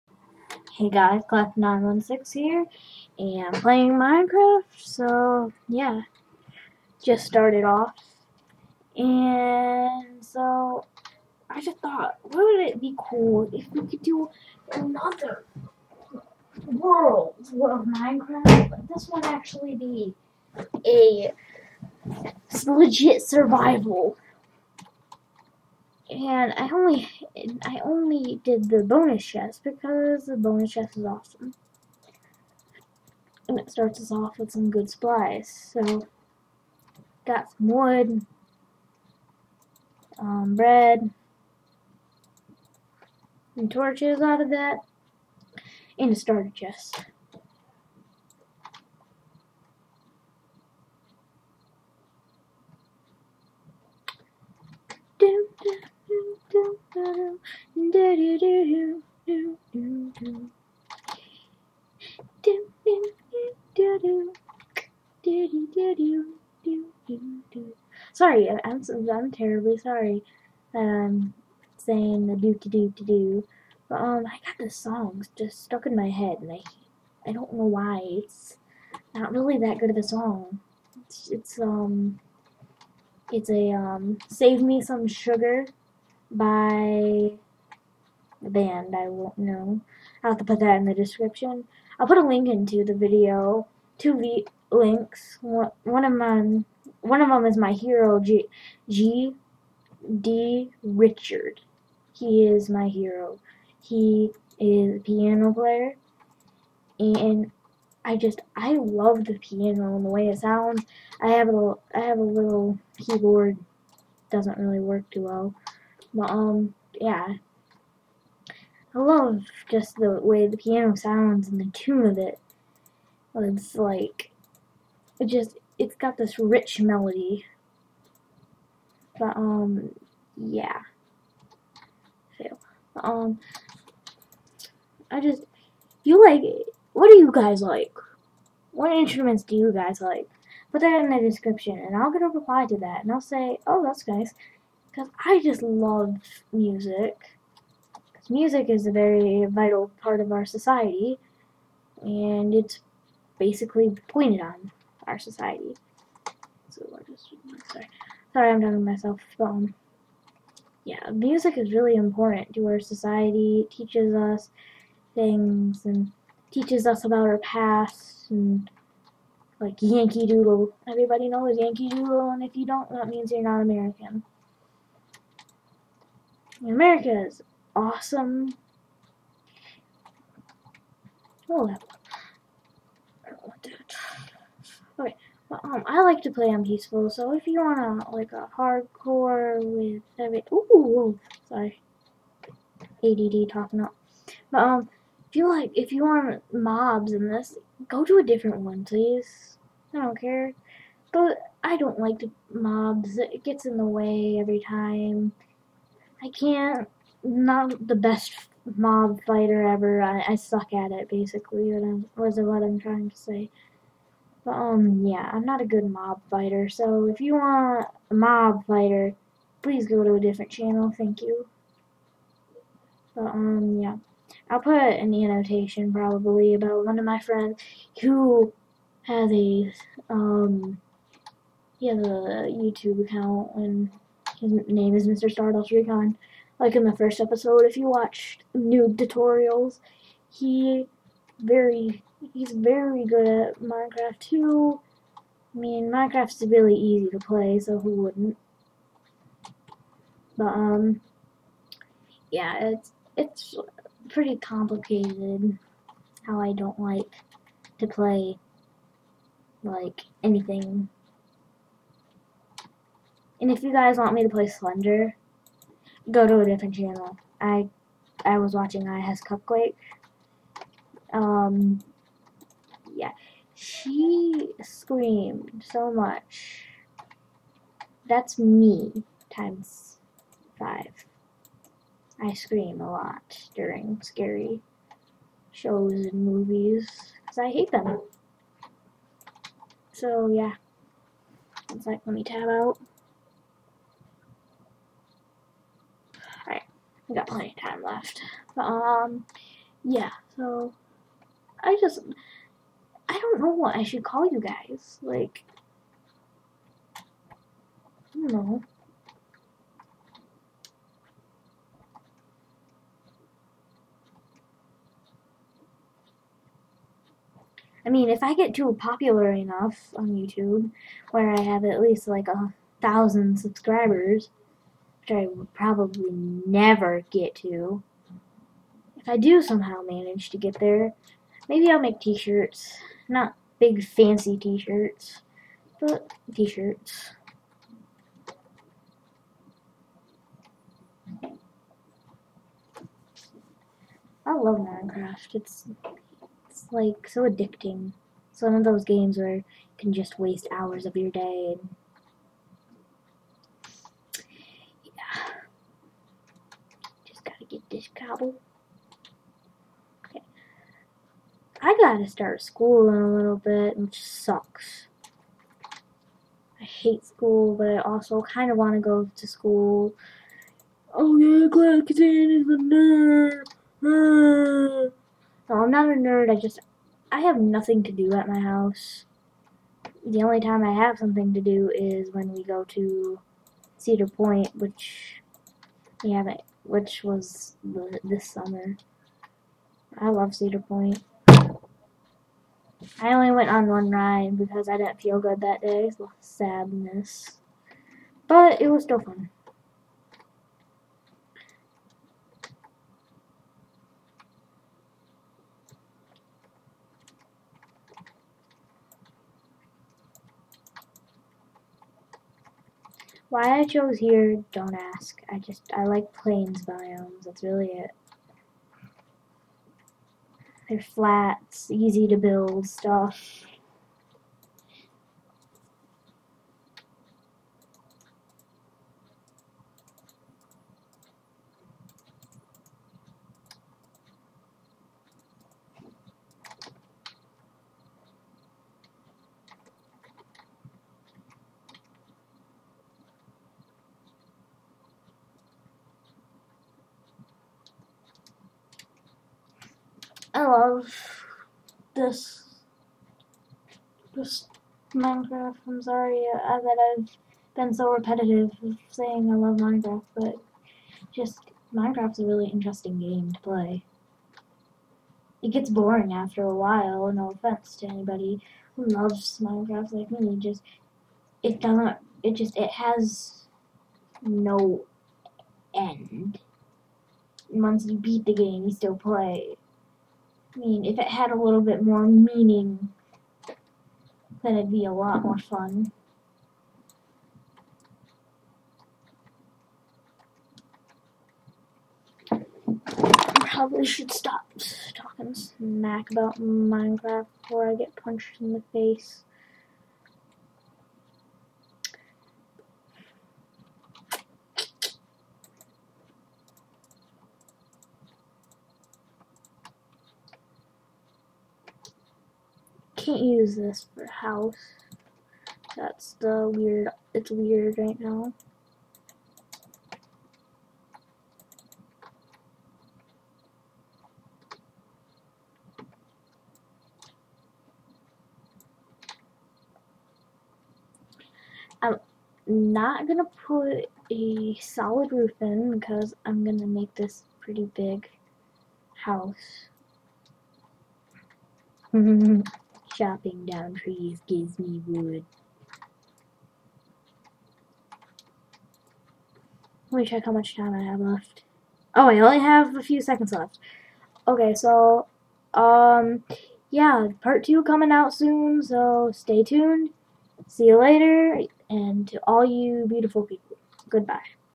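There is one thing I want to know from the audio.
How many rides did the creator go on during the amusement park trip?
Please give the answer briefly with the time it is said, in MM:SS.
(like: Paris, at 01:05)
1, at 06:33.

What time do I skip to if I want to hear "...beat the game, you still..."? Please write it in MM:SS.
07:57.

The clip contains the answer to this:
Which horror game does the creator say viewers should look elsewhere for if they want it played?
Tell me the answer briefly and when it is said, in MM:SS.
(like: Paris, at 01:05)
Slender, at 04:24.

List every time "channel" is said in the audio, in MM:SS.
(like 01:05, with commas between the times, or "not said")
03:40, 04:26.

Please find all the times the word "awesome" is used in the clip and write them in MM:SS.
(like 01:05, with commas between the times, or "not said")
00:31, 02:57.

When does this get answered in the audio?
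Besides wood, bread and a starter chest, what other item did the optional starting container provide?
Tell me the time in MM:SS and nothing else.
00:43.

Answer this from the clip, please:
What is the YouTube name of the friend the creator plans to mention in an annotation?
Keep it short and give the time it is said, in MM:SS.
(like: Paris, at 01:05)
Mr. Stardust Recon, at 03:55.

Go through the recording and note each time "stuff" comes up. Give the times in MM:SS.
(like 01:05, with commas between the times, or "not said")
07:02.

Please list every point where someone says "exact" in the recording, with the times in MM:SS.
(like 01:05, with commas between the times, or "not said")
not said.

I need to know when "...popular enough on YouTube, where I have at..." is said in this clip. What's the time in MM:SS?
05:18.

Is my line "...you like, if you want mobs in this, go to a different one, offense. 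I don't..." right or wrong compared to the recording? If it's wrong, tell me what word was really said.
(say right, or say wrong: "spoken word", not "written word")
wrong: "please", not "offense".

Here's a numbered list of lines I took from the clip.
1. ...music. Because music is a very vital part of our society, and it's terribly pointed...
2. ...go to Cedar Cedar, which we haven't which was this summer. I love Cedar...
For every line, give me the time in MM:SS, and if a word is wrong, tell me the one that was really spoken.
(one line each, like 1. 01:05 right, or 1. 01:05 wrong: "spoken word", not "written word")
1. 02:26 wrong: "basically", not "terribly"
2. 06:22 wrong: "Point", not "Cedar".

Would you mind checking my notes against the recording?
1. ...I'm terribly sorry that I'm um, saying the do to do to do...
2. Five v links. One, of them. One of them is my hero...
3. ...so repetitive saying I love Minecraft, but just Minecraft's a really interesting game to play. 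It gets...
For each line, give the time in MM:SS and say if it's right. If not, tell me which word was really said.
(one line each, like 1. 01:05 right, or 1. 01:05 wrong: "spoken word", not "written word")
1. 01:09 right
2. 01:33 wrong: "Two", not "Five"
3. 07:37 right.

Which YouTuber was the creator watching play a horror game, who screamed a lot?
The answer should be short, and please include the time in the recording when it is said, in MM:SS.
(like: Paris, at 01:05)
iHasCupquake, at 04:28.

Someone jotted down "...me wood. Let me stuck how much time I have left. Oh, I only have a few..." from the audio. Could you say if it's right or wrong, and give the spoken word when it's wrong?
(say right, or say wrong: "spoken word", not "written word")
wrong: "check", not "stuck".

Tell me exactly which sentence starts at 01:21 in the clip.
It's, it's um, it's a um, save me some sugar by the band.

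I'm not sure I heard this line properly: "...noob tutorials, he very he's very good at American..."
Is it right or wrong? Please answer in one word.
wrong.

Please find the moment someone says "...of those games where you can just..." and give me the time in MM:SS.
05:48.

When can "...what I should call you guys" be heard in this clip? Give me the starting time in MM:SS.
05:03.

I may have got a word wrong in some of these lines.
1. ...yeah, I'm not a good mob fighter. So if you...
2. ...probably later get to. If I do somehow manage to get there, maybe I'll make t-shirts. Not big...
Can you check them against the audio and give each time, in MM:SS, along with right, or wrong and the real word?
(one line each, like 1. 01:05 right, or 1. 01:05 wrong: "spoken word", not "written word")
1. 03:35 right
2. 05:25 wrong: "never", not "later".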